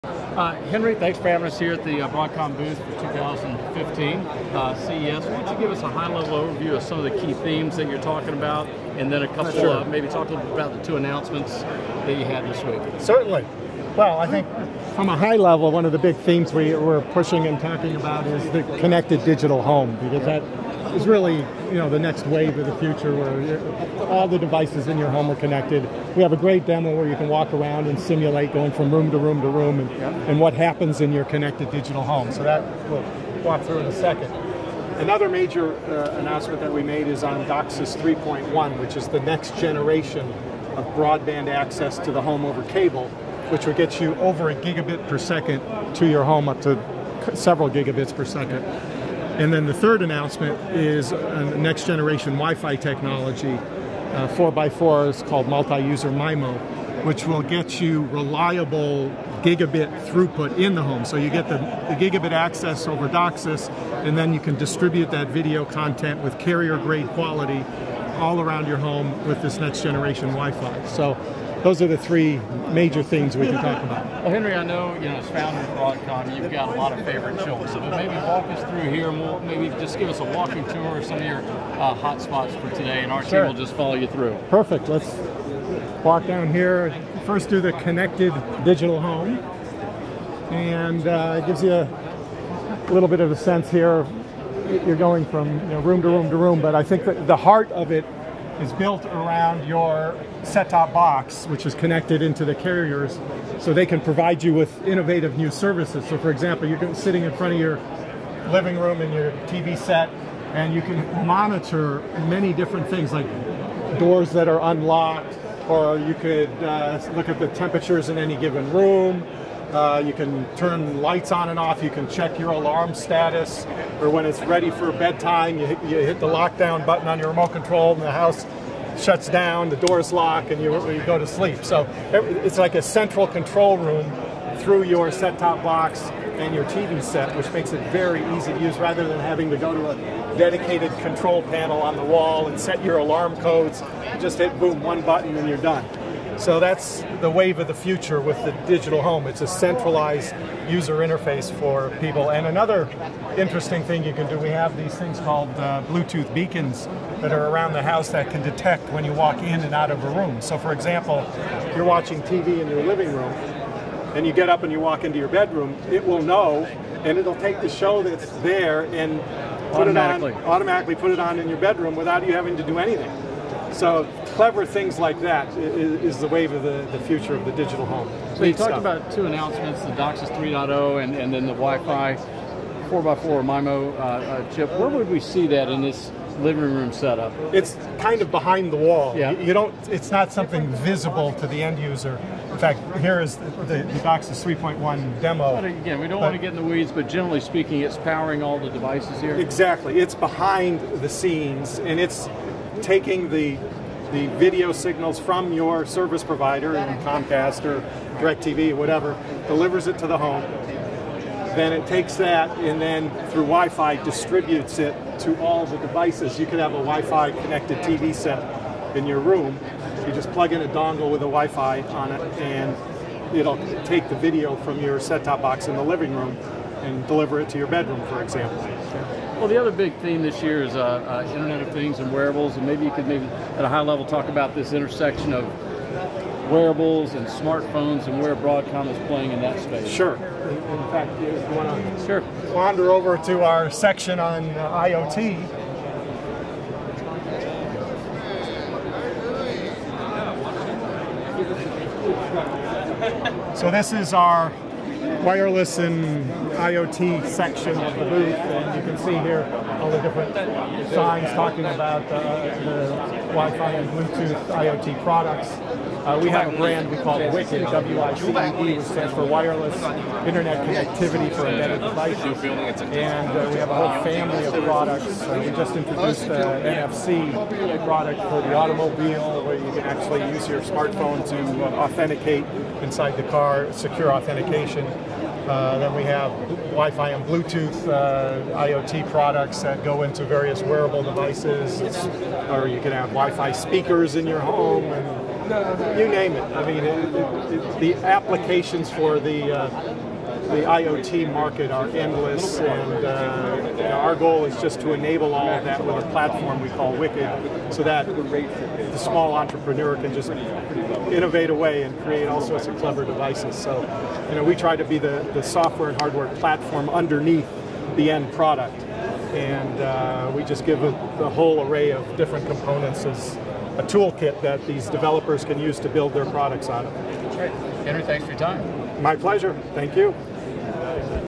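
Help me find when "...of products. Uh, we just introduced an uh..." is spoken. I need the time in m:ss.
4:34.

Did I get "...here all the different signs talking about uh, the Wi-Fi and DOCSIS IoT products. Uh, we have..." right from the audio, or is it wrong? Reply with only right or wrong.
wrong.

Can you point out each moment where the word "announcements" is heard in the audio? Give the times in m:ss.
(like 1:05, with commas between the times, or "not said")
0:10, 0:36, 0:50, 2:59.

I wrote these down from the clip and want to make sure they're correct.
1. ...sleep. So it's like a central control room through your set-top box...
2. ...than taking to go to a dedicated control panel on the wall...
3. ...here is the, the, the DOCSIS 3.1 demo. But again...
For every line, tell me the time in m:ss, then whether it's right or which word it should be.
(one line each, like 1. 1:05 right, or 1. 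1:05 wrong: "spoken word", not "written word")
1. 2:11 right
2. 2:19 wrong: "having", not "taking"
3. 3:12 right.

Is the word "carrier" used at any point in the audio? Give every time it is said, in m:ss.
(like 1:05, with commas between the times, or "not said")
1:06, 1:42.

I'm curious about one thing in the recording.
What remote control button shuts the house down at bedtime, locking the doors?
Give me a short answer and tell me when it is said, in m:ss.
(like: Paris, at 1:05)
lockdown, at 2:06.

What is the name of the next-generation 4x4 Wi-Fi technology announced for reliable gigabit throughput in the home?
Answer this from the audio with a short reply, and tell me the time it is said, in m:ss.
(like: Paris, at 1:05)
multi-user MIMO, at 0:55.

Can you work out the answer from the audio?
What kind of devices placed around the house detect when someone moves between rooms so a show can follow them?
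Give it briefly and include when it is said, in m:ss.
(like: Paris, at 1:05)
Bluetooth beacons, at 2:35.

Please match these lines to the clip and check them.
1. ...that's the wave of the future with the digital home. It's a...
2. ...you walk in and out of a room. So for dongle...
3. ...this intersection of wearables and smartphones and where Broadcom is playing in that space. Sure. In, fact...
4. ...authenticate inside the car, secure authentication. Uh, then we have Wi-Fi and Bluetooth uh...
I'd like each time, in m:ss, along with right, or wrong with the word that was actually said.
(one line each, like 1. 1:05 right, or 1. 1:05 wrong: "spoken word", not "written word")
1. 2:26 right
2. 2:39 wrong: "example", not "dongle"
3. 3:54 right
4. 4:41 right.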